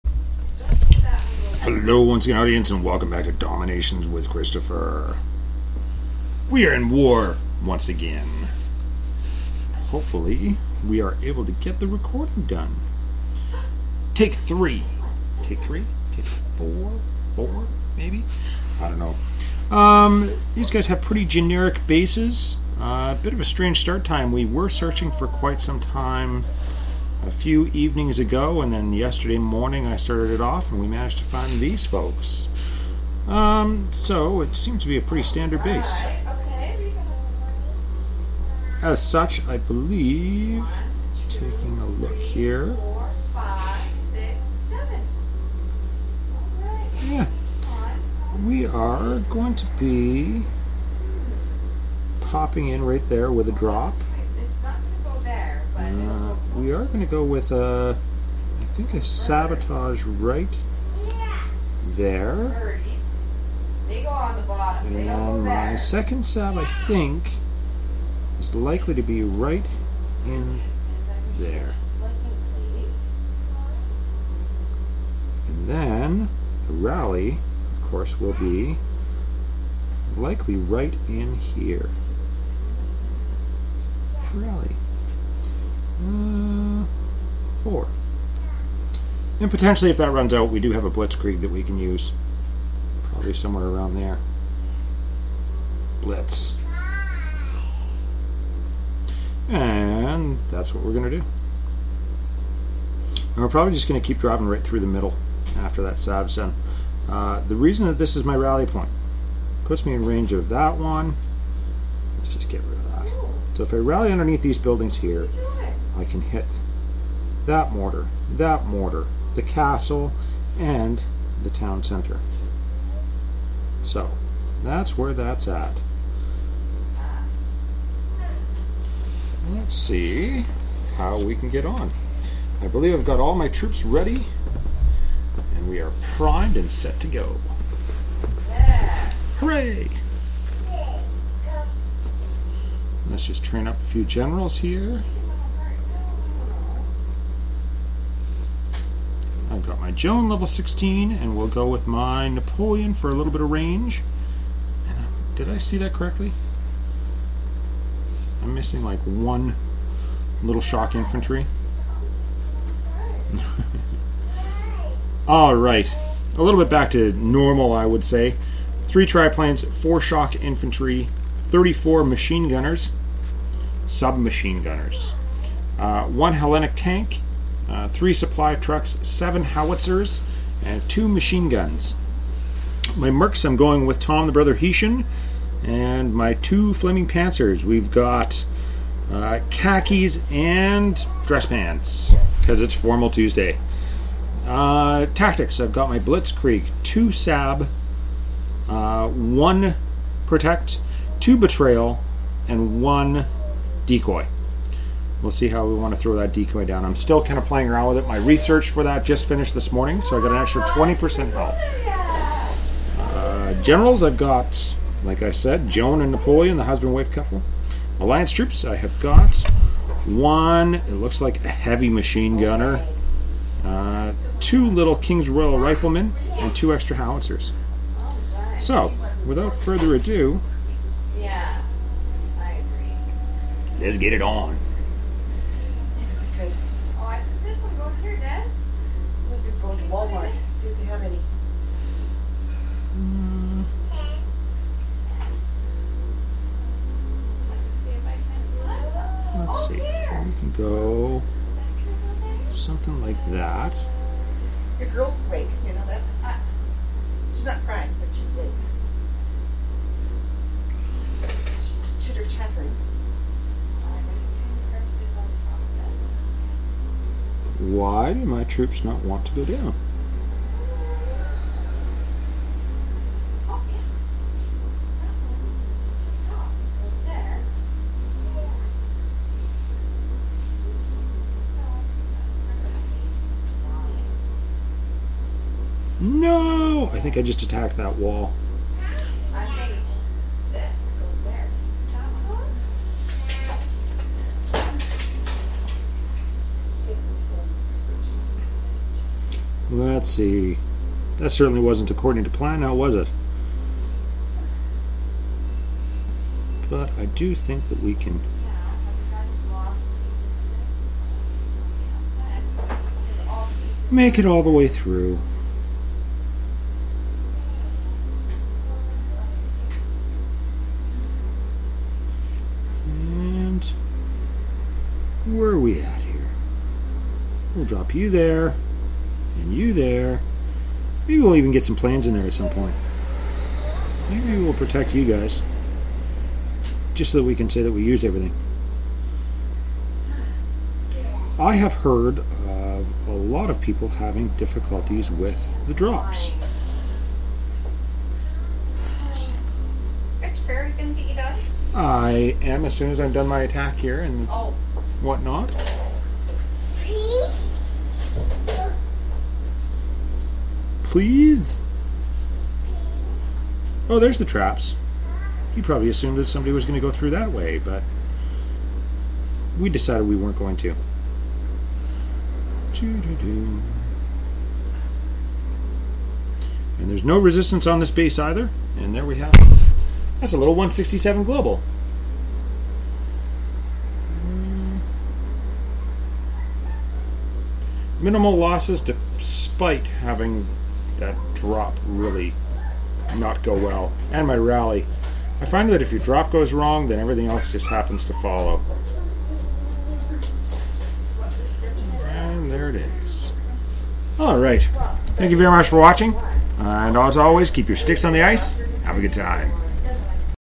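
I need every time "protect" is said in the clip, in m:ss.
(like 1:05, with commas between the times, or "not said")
3:20, 5:34.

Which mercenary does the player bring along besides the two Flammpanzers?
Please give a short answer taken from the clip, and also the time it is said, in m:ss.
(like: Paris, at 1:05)
Tom the Brother Hessian, at 3:03.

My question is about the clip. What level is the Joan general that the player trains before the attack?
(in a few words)
16.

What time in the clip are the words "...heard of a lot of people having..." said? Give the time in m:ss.
5:41.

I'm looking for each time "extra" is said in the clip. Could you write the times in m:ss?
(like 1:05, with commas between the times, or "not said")
3:30, 3:46.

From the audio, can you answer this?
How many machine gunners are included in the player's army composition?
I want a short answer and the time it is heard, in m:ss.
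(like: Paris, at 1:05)
34, at 2:51.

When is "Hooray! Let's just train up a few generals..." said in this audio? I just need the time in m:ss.
2:19.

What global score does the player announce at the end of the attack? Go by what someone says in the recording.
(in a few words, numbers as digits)
167.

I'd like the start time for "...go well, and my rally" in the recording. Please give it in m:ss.
6:33.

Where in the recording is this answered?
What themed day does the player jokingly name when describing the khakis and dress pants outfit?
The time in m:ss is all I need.
3:12.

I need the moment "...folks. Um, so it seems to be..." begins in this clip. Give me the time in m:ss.
0:31.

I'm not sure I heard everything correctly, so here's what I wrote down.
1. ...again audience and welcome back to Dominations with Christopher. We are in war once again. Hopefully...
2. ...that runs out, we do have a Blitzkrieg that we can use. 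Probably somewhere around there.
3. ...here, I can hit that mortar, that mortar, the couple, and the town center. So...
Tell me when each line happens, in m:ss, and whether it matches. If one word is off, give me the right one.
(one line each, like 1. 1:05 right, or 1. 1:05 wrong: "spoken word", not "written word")
1. 0:02 right
2. 1:29 right
3. 1:54 wrong: "castle", not "couple".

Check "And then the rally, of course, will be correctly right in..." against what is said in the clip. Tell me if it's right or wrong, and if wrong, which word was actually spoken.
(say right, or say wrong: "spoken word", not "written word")
wrong: "likely", not "correctly".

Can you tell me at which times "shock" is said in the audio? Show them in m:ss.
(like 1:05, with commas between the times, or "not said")
2:40, 2:50.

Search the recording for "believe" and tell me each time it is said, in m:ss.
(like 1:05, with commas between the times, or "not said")
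0:39, 2:12.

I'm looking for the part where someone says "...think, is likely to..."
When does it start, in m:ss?
1:06.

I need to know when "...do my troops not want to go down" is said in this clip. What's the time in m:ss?
4:28.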